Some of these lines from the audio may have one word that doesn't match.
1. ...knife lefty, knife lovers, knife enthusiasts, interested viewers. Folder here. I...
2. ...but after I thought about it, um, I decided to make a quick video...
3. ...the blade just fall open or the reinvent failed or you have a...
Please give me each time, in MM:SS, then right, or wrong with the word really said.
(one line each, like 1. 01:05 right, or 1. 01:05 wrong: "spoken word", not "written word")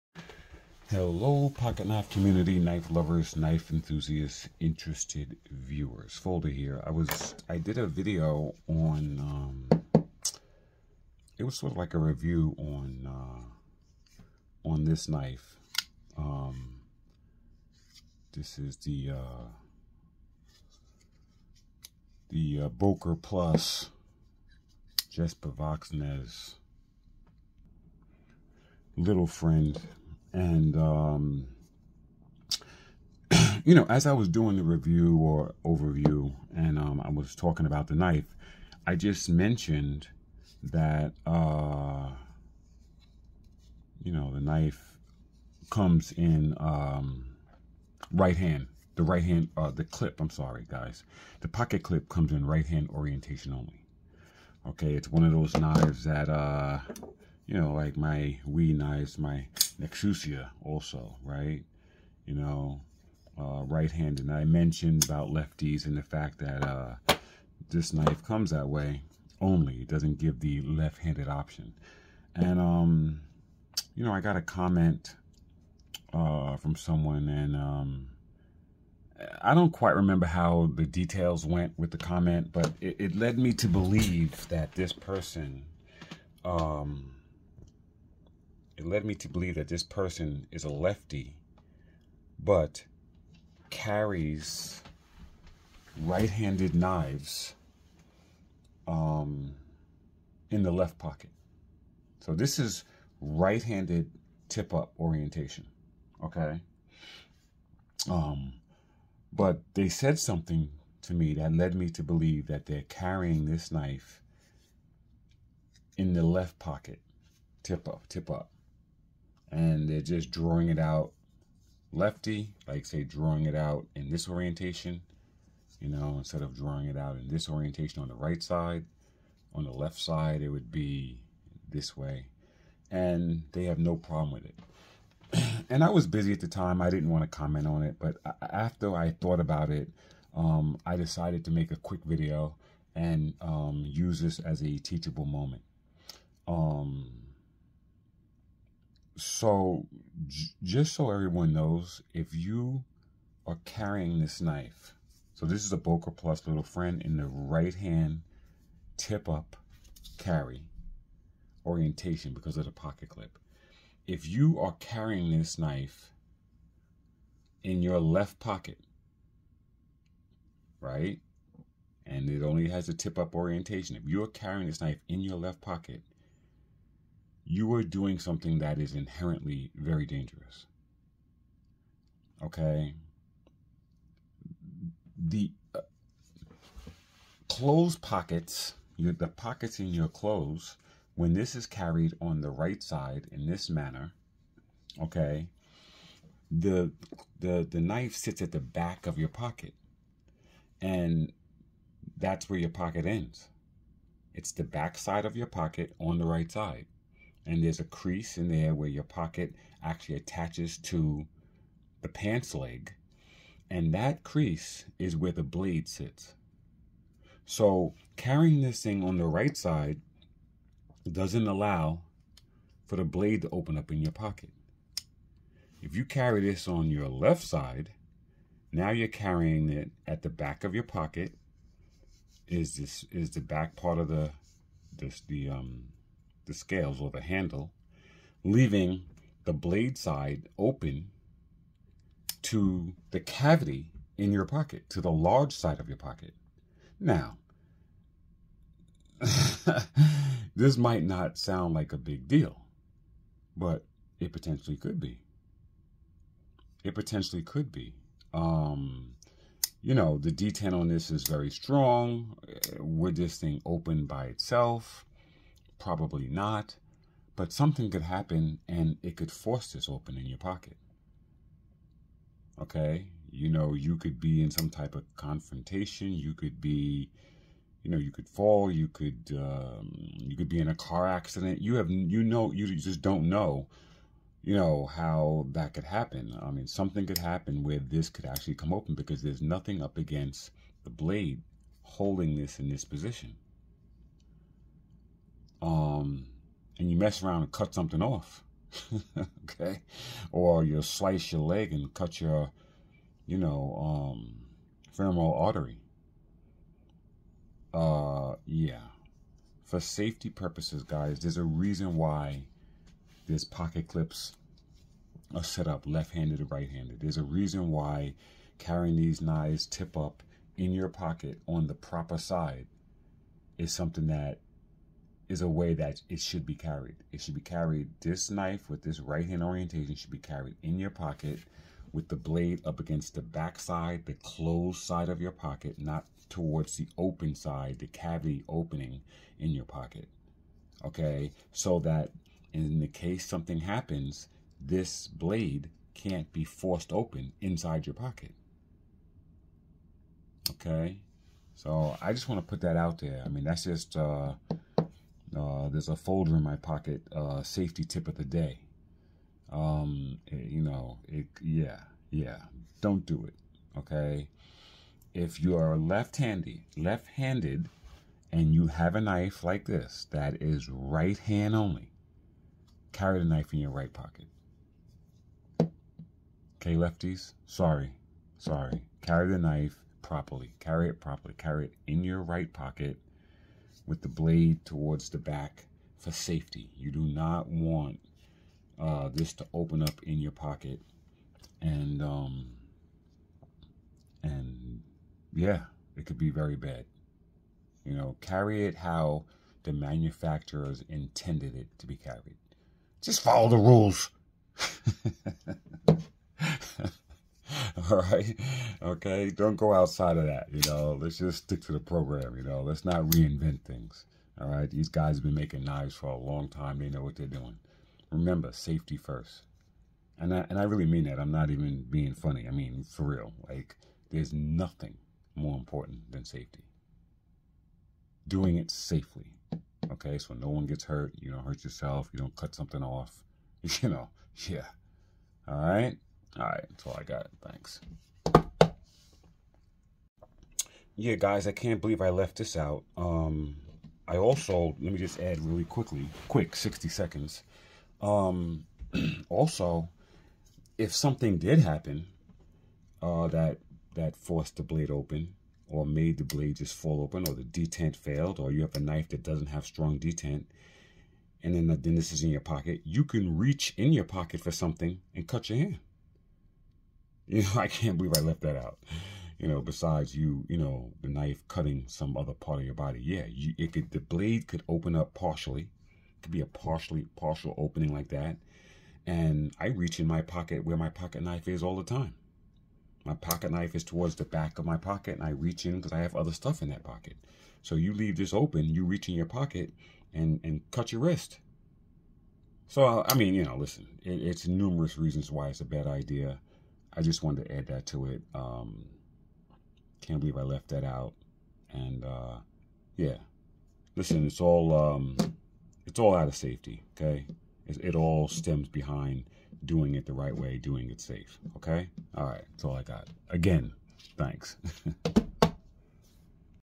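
1. 00:01 wrong: "community", not "lefty"
2. 02:17 right
3. 07:36 wrong: "detent", not "reinvent".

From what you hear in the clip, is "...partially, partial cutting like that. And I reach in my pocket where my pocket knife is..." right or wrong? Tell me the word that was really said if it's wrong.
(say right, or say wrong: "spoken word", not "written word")
wrong: "opening", not "cutting".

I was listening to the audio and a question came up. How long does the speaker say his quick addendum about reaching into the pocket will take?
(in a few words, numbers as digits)
60 seconds.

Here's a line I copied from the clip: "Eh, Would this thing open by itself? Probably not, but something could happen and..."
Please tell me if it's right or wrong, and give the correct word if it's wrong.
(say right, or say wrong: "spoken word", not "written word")
right.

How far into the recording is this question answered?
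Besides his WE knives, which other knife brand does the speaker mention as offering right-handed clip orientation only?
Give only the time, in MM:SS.
00:59.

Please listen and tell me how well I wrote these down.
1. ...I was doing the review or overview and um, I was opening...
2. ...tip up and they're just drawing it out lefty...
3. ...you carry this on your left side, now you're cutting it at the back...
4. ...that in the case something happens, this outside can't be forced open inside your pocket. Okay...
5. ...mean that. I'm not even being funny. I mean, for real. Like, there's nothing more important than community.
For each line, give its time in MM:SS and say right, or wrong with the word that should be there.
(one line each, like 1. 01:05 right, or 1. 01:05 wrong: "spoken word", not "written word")
1. 00:34 wrong: "talking", not "opening"
2. 01:58 right
3. 03:45 wrong: "carrying", not "cutting"
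4. 05:41 wrong: "blade", not "outside"
5. 07:00 wrong: "safety", not "community".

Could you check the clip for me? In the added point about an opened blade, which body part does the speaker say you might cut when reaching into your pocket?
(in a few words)
wrist.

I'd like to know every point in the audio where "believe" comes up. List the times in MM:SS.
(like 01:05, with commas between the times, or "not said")
01:23, 01:29, 01:52, 07:21, 07:47, 08:20.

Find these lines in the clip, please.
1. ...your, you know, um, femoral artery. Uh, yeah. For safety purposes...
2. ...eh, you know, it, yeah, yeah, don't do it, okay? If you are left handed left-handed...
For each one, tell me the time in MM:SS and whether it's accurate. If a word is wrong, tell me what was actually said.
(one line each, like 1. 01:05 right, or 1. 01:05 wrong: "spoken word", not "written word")
1. 05:02 right
2. 06:00 right.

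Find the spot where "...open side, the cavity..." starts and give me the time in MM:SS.
05:36.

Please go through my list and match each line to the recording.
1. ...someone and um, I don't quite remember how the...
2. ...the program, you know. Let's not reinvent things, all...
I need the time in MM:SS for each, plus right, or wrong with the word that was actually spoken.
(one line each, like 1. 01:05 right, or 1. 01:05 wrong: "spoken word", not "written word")
1. 01:16 right
2. 06:51 right.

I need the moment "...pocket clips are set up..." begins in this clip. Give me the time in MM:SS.
05:13.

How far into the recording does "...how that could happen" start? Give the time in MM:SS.
04:44.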